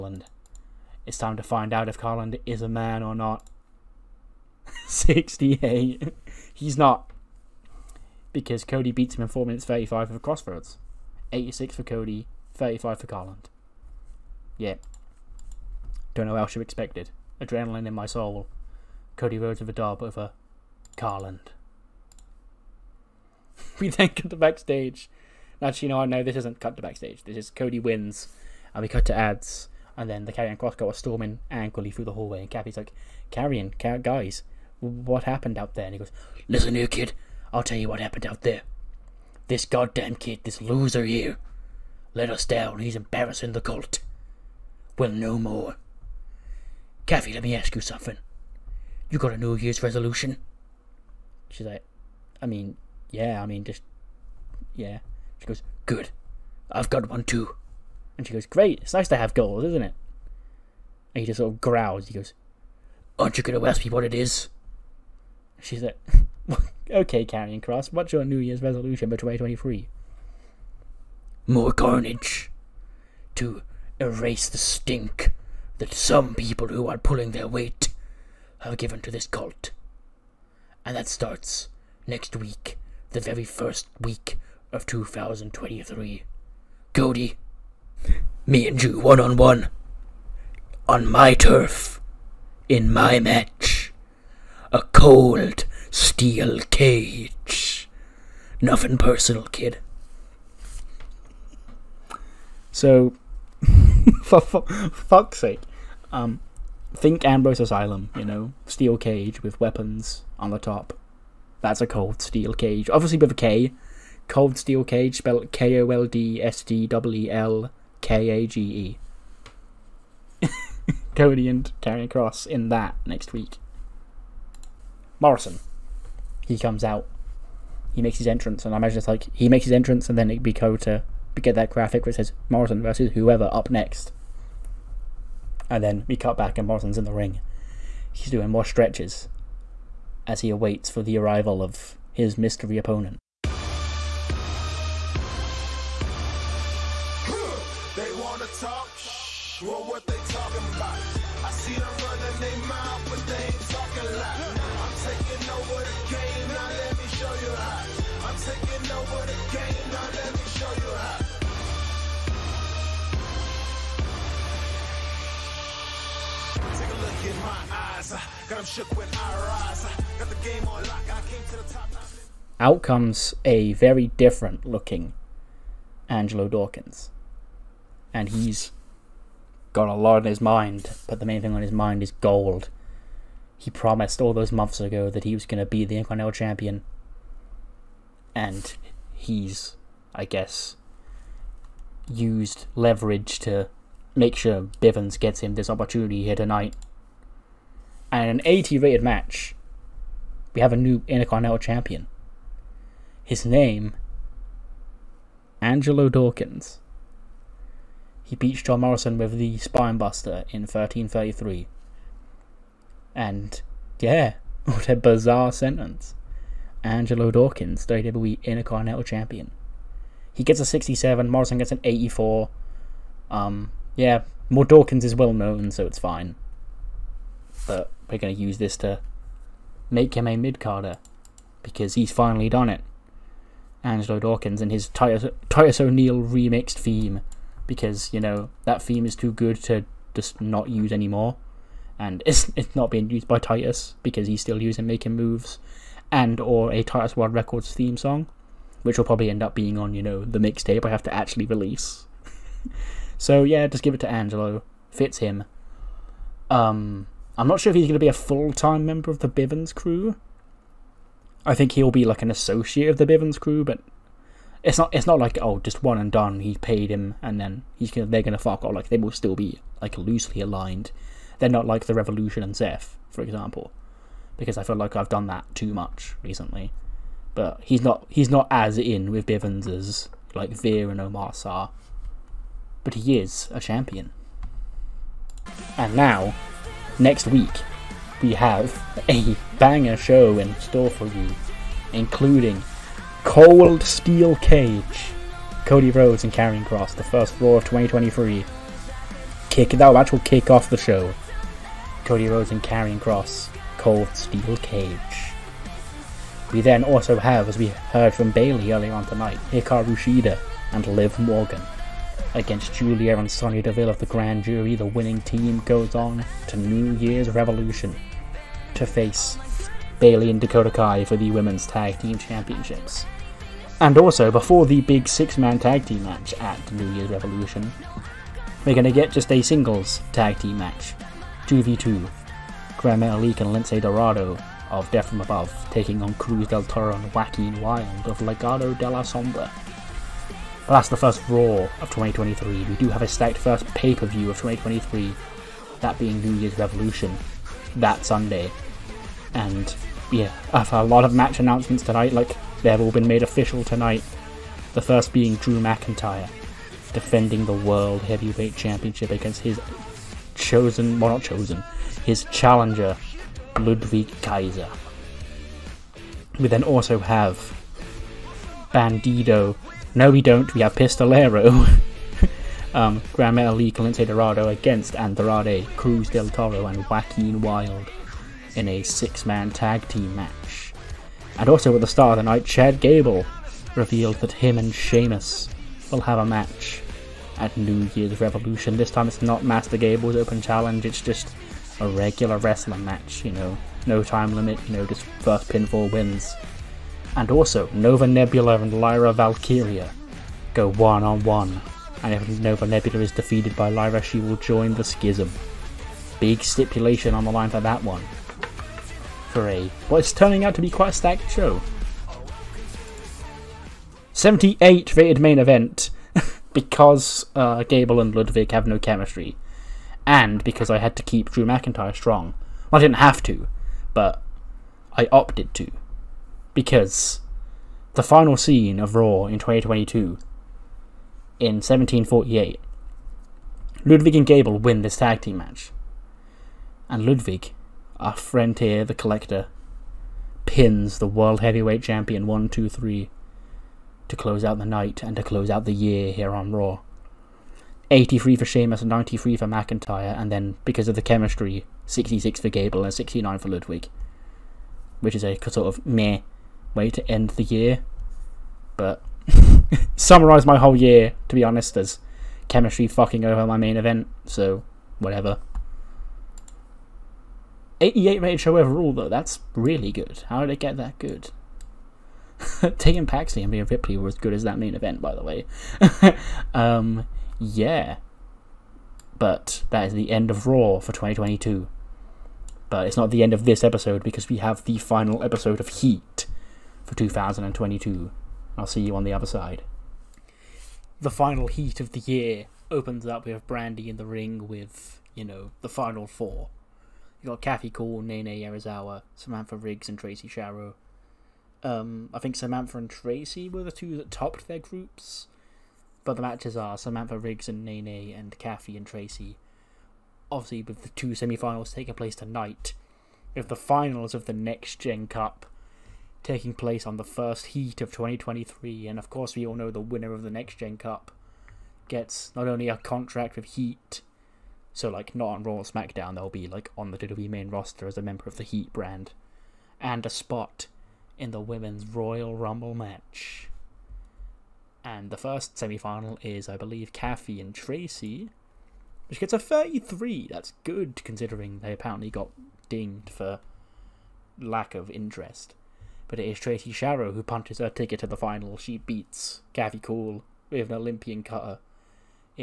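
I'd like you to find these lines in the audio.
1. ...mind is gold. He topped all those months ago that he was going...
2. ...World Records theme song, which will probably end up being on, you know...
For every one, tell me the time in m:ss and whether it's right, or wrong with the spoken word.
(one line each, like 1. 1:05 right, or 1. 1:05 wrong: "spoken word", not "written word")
1. 3:01 wrong: "promised", not "topped"
2. 4:07 right.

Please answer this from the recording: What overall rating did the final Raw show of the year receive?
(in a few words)
88.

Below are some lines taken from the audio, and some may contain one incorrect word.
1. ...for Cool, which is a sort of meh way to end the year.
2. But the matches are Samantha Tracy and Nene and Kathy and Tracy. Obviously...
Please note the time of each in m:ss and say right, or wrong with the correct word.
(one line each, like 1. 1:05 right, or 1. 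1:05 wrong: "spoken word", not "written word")
1. 7:33 wrong: "Ludwig", not "Cool"
2. 8:26 wrong: "Riggs", not "Tracy".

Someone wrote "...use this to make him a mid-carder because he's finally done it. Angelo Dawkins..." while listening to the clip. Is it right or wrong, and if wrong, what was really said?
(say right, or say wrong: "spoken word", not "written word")
right.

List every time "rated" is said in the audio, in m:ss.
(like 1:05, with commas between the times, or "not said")
3:18, 6:54, 7:48.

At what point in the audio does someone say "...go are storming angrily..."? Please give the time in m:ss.
0:30.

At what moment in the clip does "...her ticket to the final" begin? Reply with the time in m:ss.
9:07.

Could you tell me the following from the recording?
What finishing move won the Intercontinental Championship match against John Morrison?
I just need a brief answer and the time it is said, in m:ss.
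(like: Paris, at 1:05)
Spinebuster, at 3:29.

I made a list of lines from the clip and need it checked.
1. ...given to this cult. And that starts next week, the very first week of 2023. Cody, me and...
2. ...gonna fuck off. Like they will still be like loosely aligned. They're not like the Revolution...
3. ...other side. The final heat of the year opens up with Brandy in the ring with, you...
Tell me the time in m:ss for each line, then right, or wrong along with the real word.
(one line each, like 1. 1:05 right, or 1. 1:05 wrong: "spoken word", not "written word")
1. 1:18 right
2. 4:28 right
3. 8:09 right.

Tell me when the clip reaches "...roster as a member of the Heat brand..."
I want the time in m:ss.
8:47.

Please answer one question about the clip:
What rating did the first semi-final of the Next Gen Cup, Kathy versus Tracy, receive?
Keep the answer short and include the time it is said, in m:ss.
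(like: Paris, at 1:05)
33, at 8:59.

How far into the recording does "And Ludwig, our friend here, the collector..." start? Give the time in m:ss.
7:16.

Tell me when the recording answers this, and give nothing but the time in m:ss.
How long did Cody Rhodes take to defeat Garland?
0:09.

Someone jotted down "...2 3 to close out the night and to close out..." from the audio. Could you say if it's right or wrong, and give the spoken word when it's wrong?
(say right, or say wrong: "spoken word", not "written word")
right.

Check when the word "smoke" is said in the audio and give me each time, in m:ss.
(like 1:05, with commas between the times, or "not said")
not said.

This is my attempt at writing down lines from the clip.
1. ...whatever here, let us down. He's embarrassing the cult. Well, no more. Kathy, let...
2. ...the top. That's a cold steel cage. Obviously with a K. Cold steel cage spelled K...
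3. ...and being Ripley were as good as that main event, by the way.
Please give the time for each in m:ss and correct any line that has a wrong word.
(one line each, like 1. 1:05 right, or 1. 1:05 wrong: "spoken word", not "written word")
1. 0:40 wrong: "loser", not "whatever"
2. 1:50 right
3. 7:53 right.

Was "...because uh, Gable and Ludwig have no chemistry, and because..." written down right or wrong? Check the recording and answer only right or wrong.
right.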